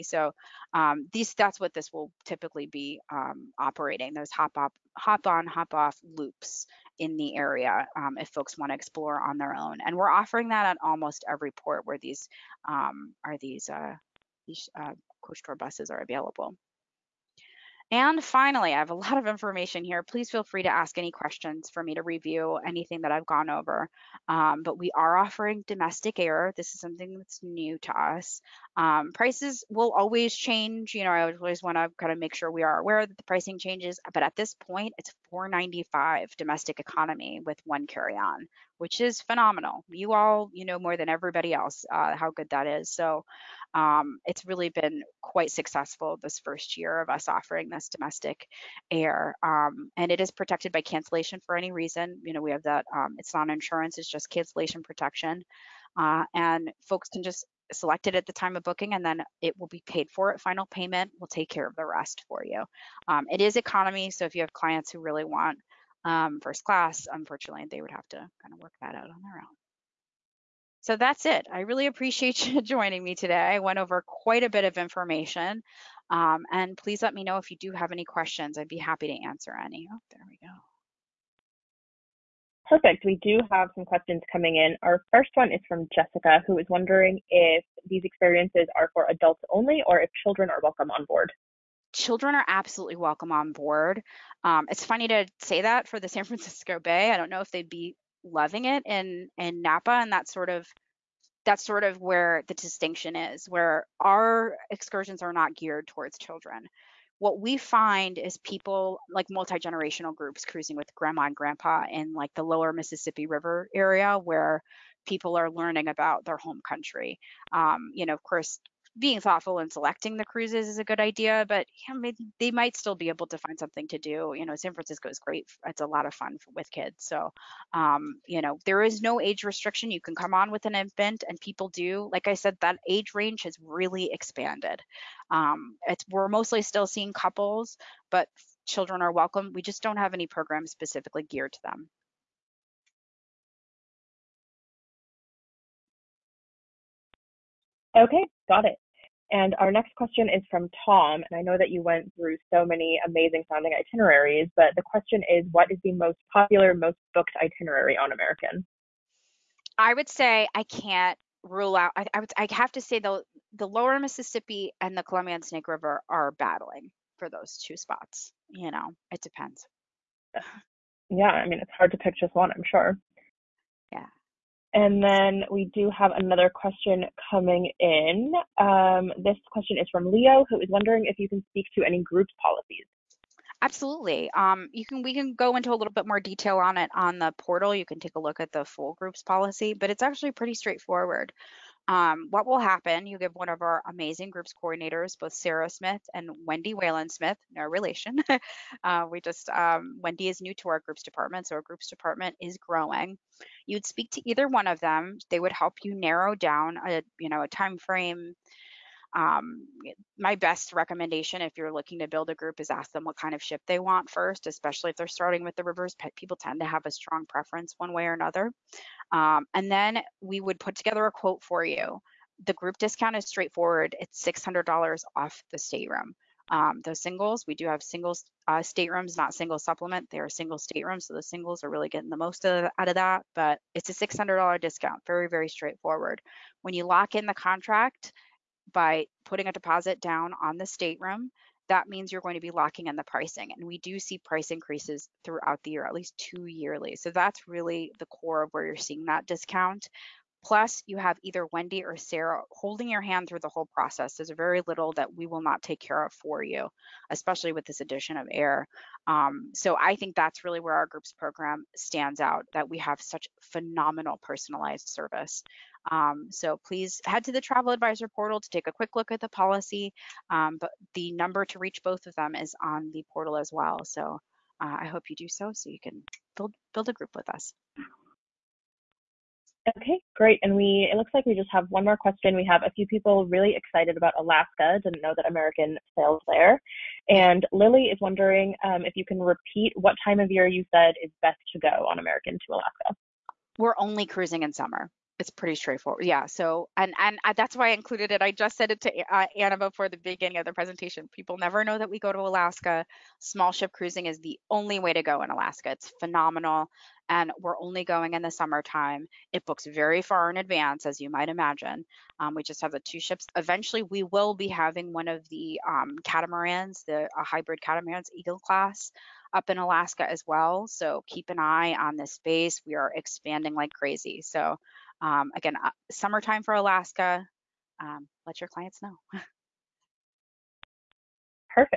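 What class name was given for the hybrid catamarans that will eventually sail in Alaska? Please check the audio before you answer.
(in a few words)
Eagle class.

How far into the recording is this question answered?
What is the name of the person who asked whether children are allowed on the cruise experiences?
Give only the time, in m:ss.
1:25.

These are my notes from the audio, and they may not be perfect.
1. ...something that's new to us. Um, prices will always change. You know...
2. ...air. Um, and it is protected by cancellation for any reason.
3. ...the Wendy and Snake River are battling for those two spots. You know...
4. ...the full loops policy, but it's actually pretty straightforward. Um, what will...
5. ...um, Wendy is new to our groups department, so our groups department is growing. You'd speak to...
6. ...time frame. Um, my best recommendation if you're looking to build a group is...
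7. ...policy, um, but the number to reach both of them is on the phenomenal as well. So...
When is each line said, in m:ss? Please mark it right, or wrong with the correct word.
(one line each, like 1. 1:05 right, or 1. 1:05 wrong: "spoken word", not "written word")
1. 0:26 right
2. 0:48 right
3. 2:44 wrong: "Columbia", not "Wendy"
4. 3:08 wrong: "groups", not "loops"
5. 3:19 right
6. 3:27 right
7. 4:29 wrong: "portal", not "phenomenal".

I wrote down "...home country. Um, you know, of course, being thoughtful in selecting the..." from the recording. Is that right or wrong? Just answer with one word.
right.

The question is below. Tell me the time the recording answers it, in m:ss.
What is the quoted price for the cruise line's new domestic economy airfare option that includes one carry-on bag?
0:35.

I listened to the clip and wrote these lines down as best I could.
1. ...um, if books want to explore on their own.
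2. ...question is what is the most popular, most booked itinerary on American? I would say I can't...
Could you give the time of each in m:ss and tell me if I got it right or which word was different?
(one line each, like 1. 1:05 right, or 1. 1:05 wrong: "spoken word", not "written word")
1. 0:07 wrong: "folks", not "books"
2. 2:34 right.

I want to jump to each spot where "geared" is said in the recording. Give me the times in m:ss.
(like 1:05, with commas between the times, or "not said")
1:45, 2:21.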